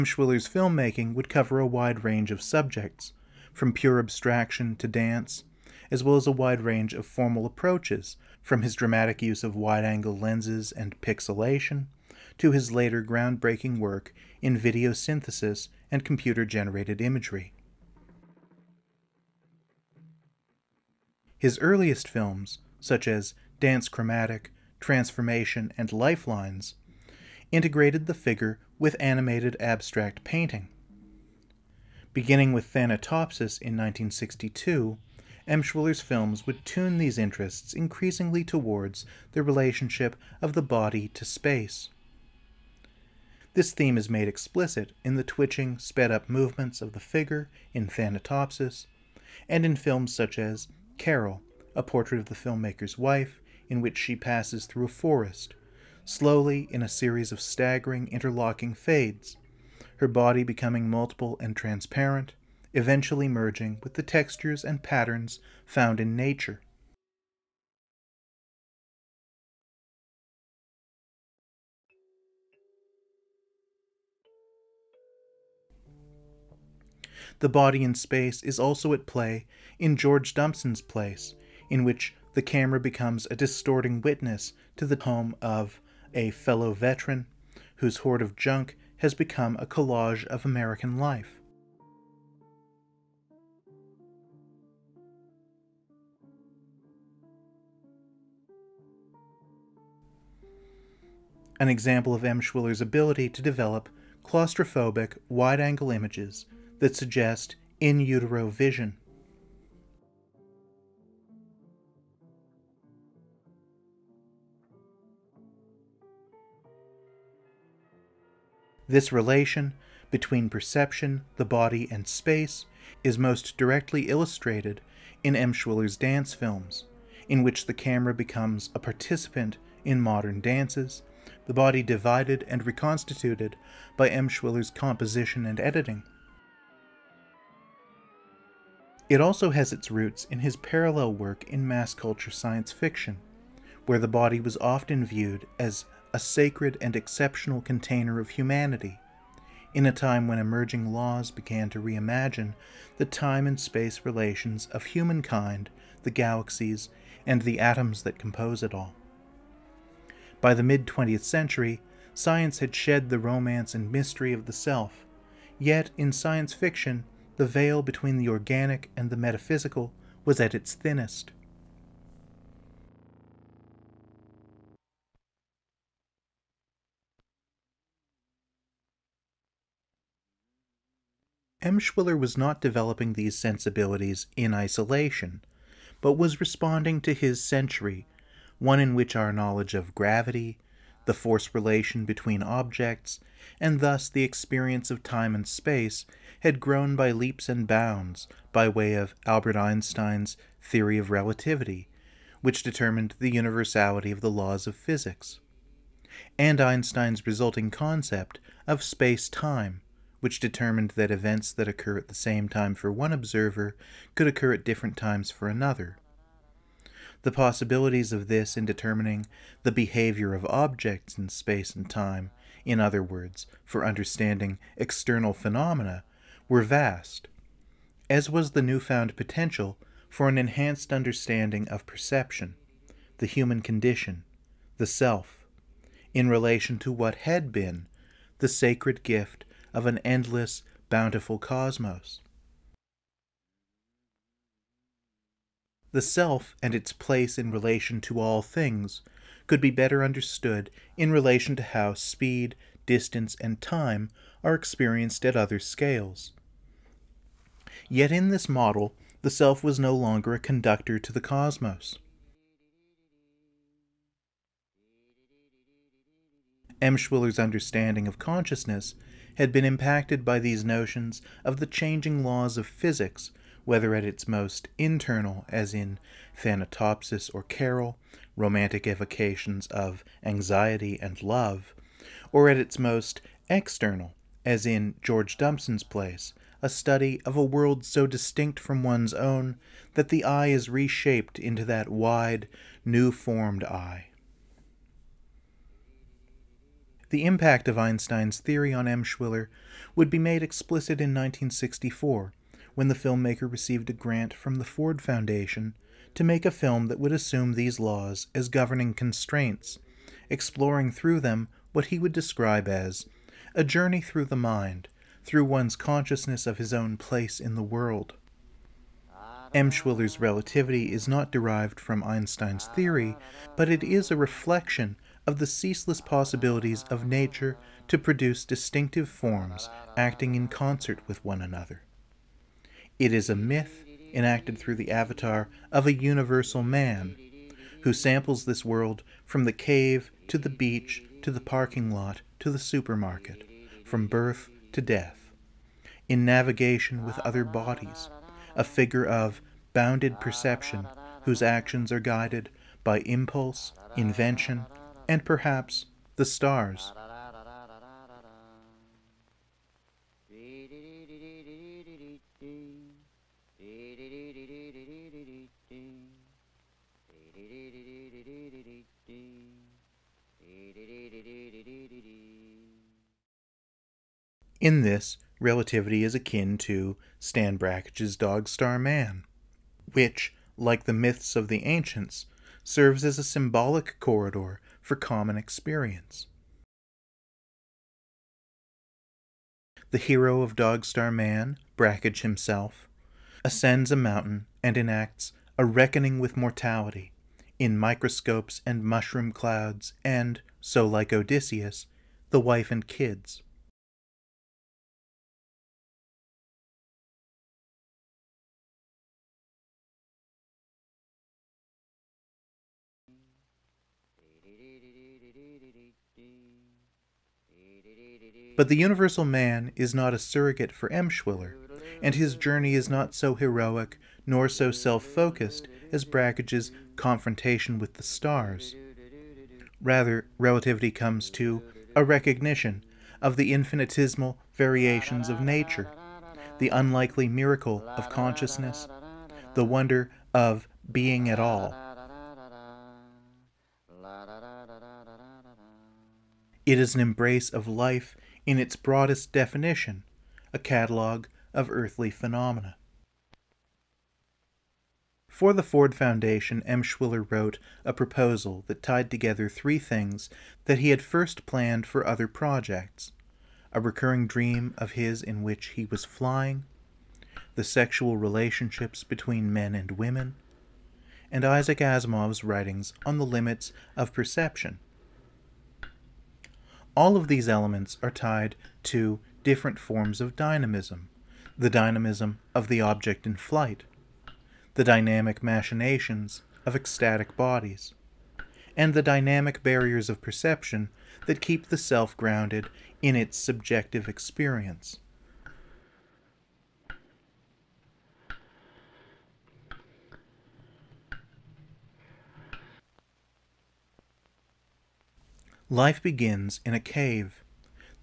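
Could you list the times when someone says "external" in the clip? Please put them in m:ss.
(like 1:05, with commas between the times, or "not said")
3:44, 4:43.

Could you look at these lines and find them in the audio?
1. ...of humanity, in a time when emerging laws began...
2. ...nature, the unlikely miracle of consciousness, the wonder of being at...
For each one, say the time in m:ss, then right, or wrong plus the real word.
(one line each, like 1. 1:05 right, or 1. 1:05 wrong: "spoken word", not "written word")
1. 2:28 right
2. 7:15 right.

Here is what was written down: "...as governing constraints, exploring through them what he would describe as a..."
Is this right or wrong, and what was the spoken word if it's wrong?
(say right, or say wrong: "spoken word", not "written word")
right.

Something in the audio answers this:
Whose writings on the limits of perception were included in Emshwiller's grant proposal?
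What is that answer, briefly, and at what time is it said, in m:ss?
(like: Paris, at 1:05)
Isaac Asimov, at 7:51.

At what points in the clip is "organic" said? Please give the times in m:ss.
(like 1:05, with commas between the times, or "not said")
2:48.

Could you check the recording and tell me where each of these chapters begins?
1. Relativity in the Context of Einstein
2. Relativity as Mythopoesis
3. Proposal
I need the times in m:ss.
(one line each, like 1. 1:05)
1. 2:57
2. 6:09
3. 7:34.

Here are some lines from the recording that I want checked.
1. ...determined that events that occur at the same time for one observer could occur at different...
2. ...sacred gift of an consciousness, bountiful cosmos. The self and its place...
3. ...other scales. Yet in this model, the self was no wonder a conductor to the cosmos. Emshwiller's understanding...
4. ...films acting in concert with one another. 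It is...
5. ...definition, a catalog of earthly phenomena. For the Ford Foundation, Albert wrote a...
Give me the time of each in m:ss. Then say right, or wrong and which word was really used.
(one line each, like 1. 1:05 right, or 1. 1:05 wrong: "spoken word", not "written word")
1. 3:30 right
2. 3:58 wrong: "endless", not "consciousness"
3. 4:15 wrong: "longer", not "wonder"
4. 5:29 wrong: "forms", not "films"
5. 7:29 wrong: "Emshwiller", not "Albert".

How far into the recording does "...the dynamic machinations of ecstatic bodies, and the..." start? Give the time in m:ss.
8:04.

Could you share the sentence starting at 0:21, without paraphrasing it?
His earliest films, such as Dance Chromatic, Transformation, and Lifelines, integrated the figure with animated abstract painting.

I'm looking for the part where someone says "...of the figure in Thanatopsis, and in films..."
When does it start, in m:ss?
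0:46.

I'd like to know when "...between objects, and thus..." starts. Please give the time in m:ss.
3:12.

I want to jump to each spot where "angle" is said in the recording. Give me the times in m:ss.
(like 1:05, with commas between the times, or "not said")
0:09, 1:45.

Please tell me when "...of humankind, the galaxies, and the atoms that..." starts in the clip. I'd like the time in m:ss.
2:34.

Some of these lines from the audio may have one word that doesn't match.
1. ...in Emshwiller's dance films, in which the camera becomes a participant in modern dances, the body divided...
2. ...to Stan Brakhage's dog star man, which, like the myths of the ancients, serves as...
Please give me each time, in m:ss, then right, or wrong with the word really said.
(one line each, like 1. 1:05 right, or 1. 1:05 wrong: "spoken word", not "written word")
1. 2:05 right
2. 6:16 right.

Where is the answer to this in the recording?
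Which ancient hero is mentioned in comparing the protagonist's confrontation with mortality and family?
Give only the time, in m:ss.
6:41.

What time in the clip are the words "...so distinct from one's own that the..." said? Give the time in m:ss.
4:47.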